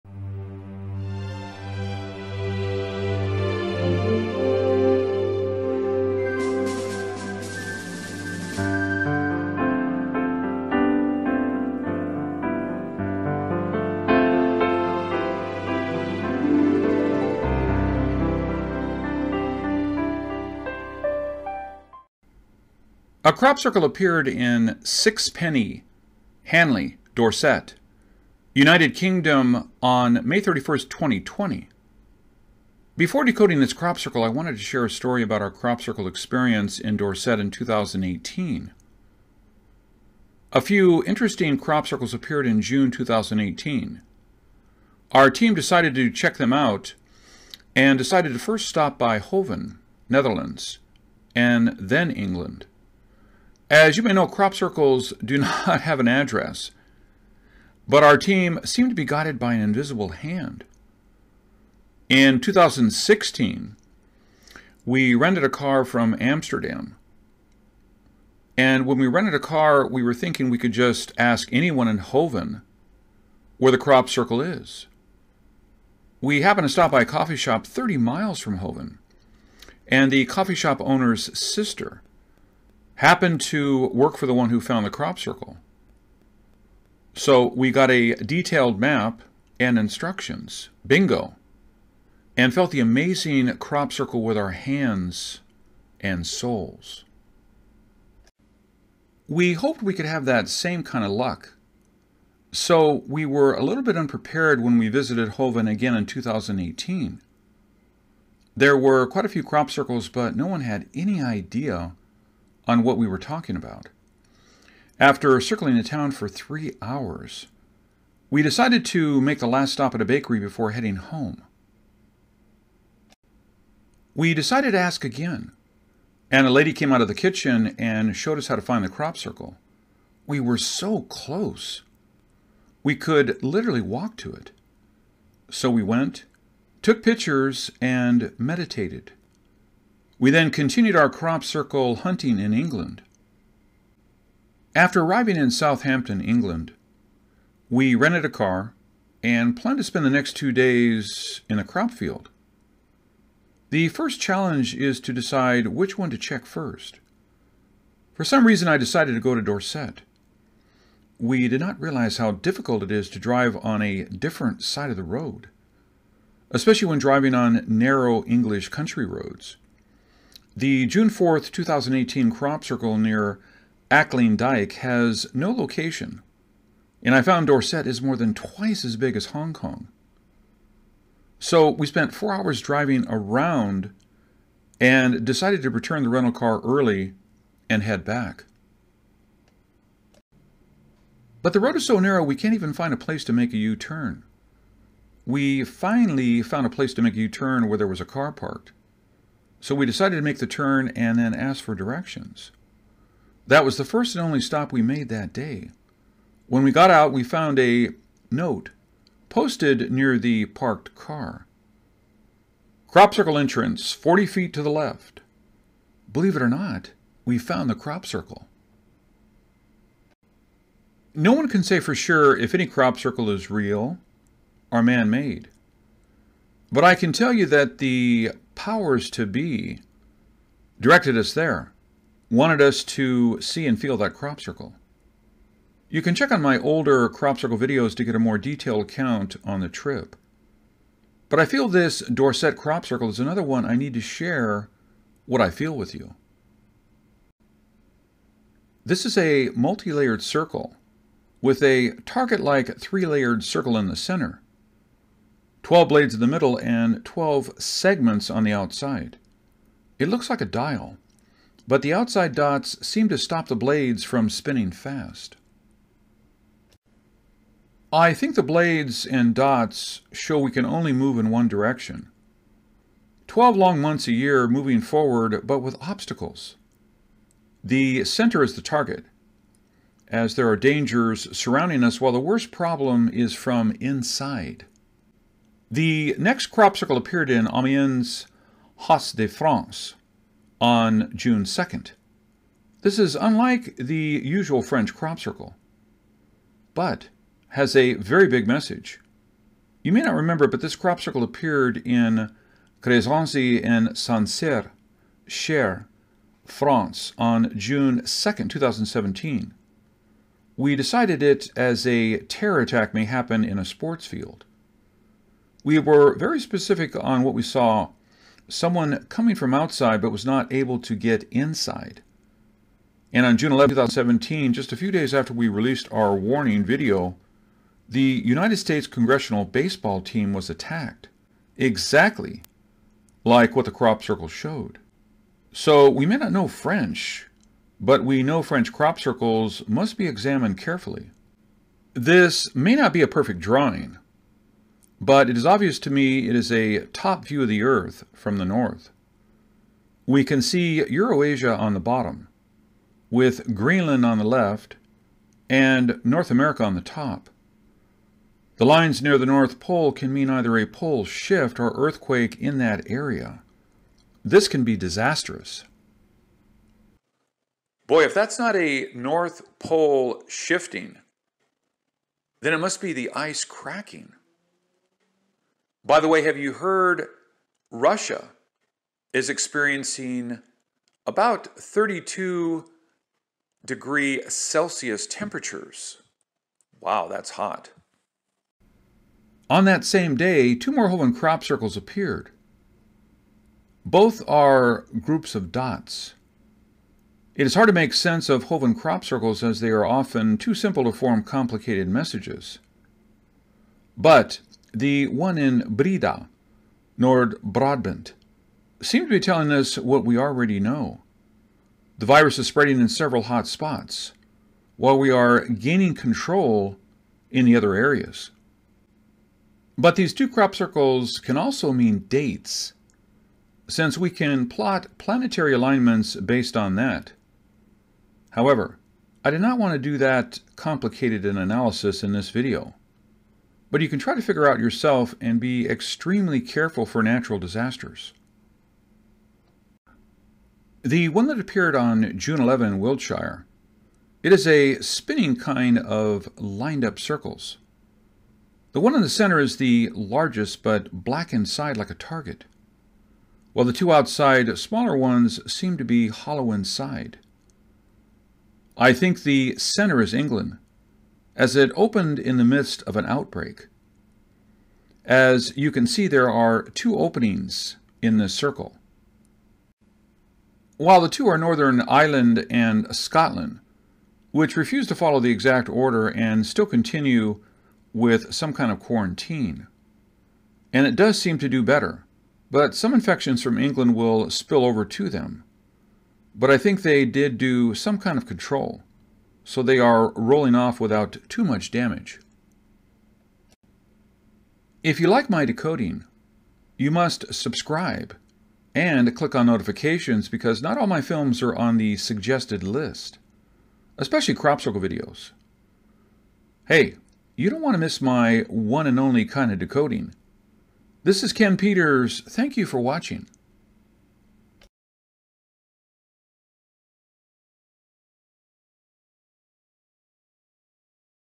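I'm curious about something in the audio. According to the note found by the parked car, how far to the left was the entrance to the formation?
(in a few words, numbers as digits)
40 feet.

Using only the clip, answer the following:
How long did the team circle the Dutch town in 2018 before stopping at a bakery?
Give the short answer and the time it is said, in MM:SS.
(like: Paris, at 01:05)
3 hours, at 01:56.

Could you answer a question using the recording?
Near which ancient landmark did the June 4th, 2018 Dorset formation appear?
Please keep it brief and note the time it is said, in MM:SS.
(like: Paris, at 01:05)
Ackling Dyke, at 02:53.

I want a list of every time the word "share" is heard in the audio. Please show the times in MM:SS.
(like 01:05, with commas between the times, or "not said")
00:34, 04:03.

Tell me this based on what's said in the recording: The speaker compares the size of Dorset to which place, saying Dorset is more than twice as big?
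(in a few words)
Hong Kong.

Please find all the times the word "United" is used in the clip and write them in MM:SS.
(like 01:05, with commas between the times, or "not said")
00:28, 05:28.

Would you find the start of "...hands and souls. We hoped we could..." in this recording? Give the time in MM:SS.
01:34.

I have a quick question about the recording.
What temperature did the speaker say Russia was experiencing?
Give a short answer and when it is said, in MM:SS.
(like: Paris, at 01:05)
32 degrees Celsius, at 06:21.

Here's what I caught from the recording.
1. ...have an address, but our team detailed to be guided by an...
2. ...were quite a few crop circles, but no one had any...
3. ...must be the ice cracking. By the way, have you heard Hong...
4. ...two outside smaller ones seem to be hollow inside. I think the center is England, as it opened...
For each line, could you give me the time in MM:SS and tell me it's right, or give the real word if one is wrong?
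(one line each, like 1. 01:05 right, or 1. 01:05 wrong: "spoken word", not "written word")
1. 00:55 wrong: "seemed", not "detailed"
2. 01:48 right
3. 06:12 wrong: "Russia", not "Hong"
4. 07:33 right.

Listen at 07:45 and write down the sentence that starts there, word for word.
As you can see, there are two openings in this circle.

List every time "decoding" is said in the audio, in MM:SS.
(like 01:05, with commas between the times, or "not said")
00:33, 08:15, 08:29.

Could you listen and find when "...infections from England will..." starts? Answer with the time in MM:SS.
08:02.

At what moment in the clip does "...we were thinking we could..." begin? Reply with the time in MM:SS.
01:09.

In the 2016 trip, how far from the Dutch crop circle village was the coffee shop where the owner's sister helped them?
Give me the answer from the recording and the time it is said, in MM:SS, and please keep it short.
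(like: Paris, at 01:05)
30 miles, at 01:17.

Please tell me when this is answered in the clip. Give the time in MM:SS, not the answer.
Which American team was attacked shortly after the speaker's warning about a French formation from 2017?
05:28.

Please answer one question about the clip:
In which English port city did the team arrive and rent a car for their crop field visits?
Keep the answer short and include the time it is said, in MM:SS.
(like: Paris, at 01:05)
Southampton, at 02:25.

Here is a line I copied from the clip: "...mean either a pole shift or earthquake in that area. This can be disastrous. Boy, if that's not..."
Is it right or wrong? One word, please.
right.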